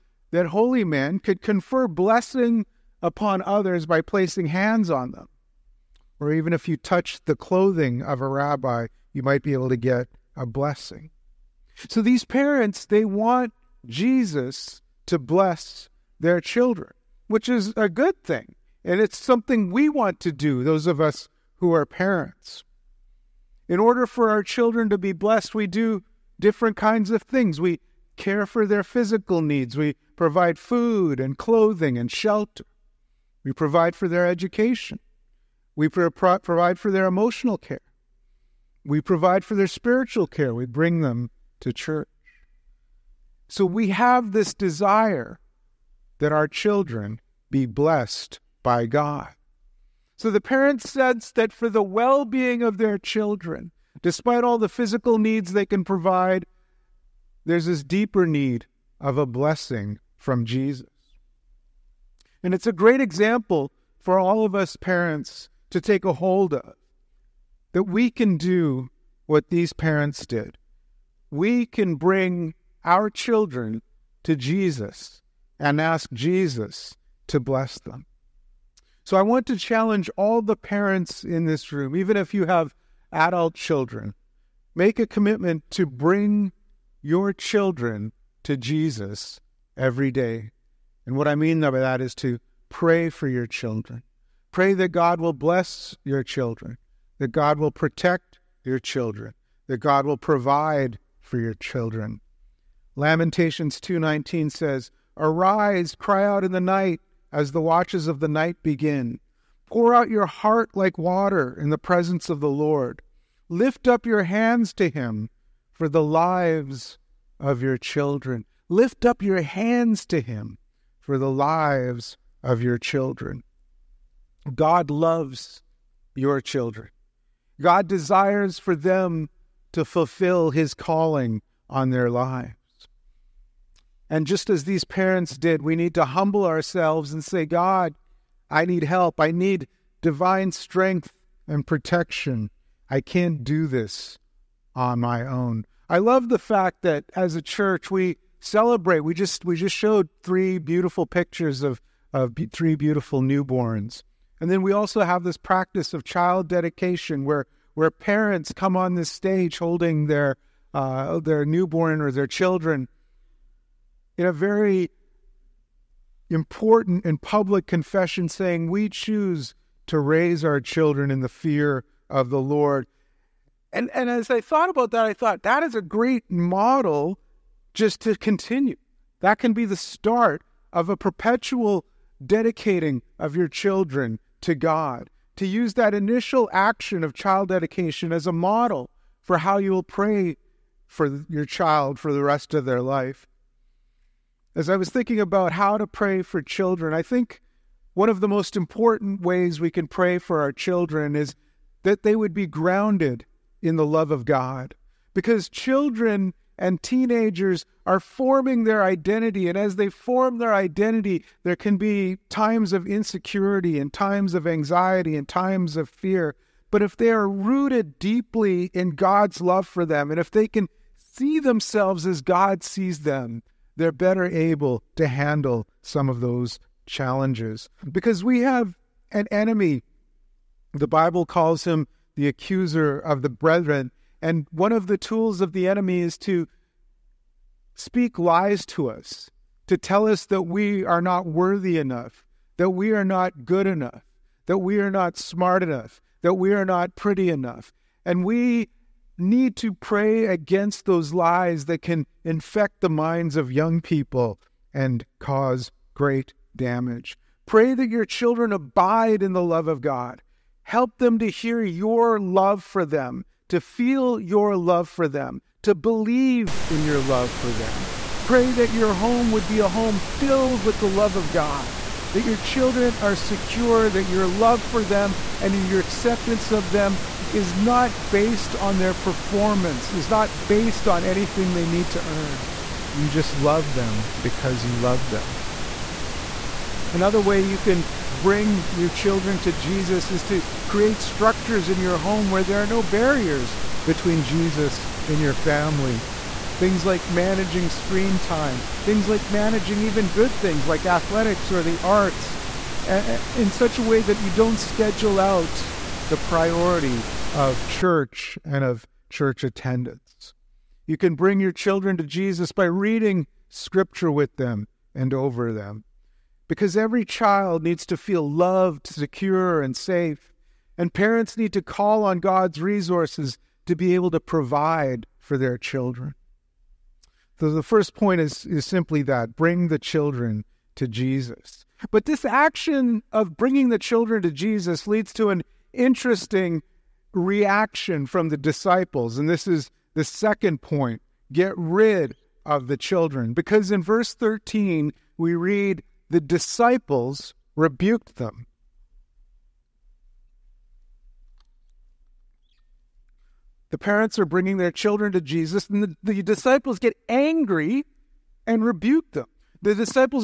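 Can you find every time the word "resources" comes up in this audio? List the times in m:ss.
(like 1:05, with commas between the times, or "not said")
5:22.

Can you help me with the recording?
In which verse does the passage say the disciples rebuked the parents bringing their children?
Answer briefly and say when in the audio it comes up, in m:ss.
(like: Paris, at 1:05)
Verse 13, at 5:43.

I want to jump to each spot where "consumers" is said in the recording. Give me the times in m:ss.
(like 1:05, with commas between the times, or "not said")
not said.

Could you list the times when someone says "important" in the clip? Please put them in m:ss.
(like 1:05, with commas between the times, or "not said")
2:46, 3:18.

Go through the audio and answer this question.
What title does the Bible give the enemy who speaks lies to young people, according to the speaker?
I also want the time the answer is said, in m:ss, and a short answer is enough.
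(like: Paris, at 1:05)
Accuser of the brethren, at 3:52.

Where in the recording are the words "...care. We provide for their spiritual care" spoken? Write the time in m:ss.
0:37.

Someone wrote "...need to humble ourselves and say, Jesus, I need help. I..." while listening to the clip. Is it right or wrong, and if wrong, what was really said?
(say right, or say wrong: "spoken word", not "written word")
wrong: "God", not "Jesus".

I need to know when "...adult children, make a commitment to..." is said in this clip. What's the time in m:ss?
1:23.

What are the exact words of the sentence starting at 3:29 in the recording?
And as they form their identity, there can be times of insecurity and times of anxiety and times of fear.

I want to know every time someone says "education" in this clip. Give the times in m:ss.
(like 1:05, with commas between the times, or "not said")
0:34.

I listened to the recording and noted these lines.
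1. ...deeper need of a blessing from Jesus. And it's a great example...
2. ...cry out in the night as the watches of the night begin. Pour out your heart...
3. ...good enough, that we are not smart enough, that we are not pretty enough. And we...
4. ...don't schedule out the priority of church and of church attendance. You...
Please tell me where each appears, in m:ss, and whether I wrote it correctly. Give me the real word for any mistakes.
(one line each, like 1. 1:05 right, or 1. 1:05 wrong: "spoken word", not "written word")
1. 0:57 right
2. 1:45 right
3. 4:03 right
4. 5:04 right.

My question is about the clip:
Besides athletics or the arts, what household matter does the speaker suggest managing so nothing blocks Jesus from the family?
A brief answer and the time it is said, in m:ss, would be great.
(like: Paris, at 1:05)
Screen time, at 4:57.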